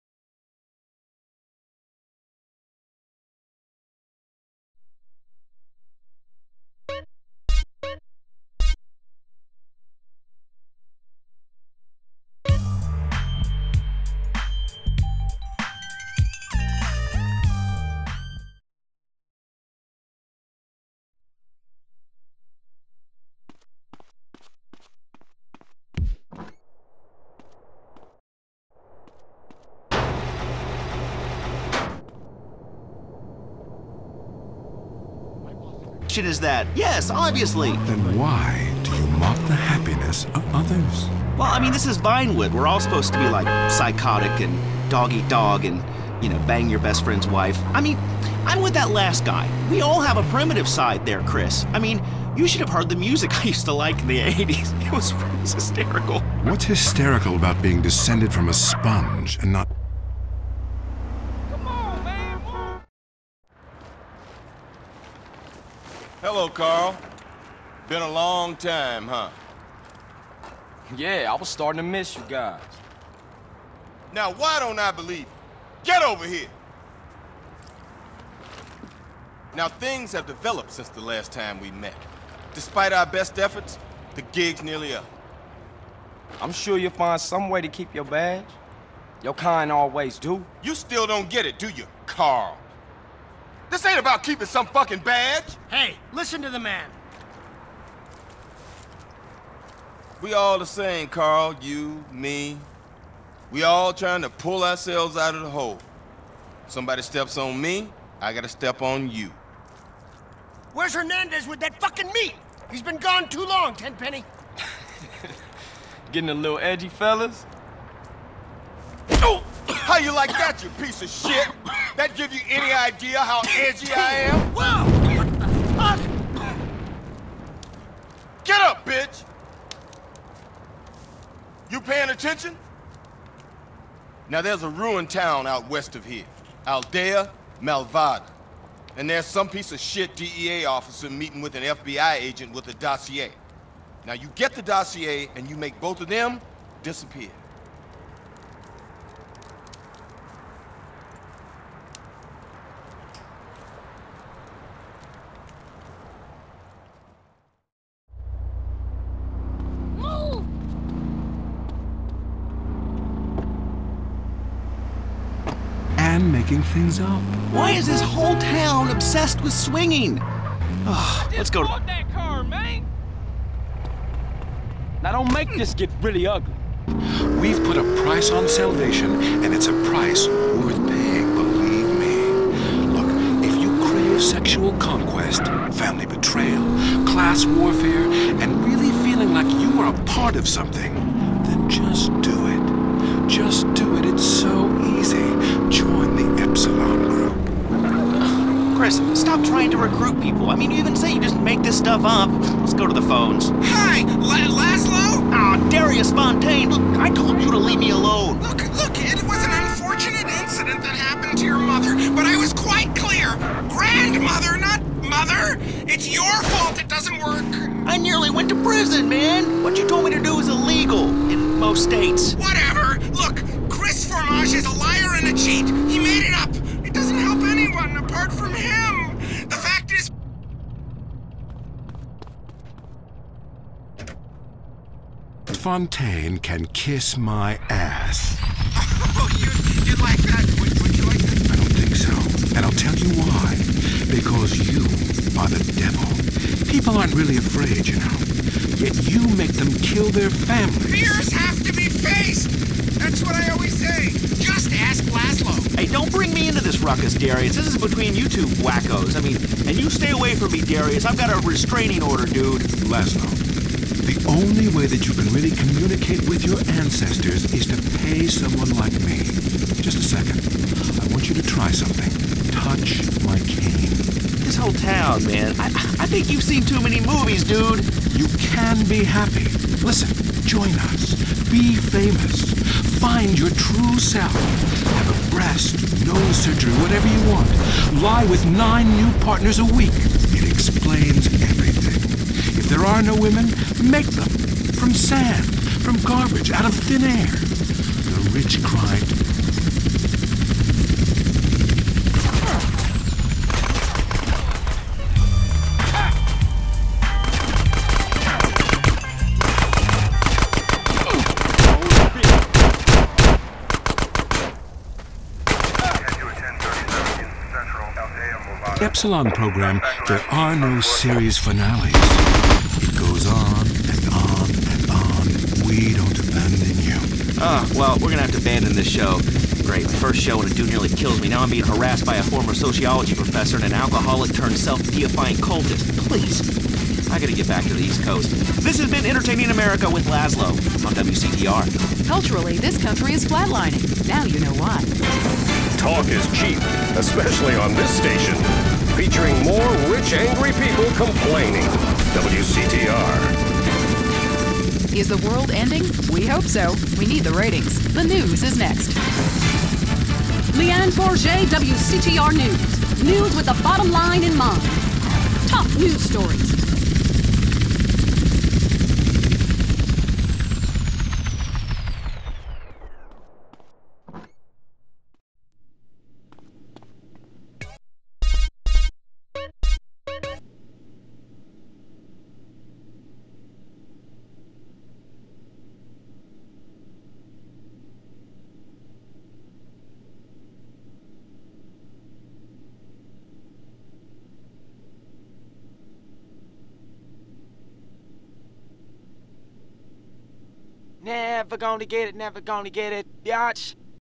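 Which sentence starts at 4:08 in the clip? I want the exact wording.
Yet you make them kill their families.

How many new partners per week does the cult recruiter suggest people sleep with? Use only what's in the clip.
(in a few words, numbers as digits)
9.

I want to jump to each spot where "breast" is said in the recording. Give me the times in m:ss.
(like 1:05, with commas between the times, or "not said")
4:45.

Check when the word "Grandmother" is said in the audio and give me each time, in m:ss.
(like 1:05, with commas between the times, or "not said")
3:33.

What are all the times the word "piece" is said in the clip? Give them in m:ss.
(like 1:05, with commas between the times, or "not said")
2:00, 2:19.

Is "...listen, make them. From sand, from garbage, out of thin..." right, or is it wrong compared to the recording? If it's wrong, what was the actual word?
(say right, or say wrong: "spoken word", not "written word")
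wrong: "women", not "listen".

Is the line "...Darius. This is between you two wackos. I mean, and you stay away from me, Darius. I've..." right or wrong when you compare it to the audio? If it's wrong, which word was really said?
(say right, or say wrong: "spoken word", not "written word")
right.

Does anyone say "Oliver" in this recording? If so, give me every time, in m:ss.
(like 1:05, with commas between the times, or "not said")
not said.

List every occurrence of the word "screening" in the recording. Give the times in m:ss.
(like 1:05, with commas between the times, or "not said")
not said.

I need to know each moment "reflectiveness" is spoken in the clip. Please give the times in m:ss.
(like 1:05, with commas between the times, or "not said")
not said.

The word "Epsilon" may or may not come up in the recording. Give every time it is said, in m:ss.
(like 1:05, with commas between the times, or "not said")
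3:16, 5:18.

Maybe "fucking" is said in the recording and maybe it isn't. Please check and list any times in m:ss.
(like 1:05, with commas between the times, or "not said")
1:34, 1:51.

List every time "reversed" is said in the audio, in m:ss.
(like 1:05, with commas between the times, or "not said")
not said.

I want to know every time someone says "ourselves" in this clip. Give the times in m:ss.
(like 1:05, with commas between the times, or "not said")
1:44.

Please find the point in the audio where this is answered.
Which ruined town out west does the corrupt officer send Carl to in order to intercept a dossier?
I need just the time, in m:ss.
2:16.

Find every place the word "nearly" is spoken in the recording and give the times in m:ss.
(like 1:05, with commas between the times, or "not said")
1:24, 3:37, 5:30.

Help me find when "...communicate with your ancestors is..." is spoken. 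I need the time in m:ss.
4:25.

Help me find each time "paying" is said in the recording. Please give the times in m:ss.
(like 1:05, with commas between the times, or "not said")
2:11, 3:00.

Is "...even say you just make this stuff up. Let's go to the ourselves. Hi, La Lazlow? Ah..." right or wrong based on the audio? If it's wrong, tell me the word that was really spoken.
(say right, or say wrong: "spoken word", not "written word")
wrong: "phones", not "ourselves".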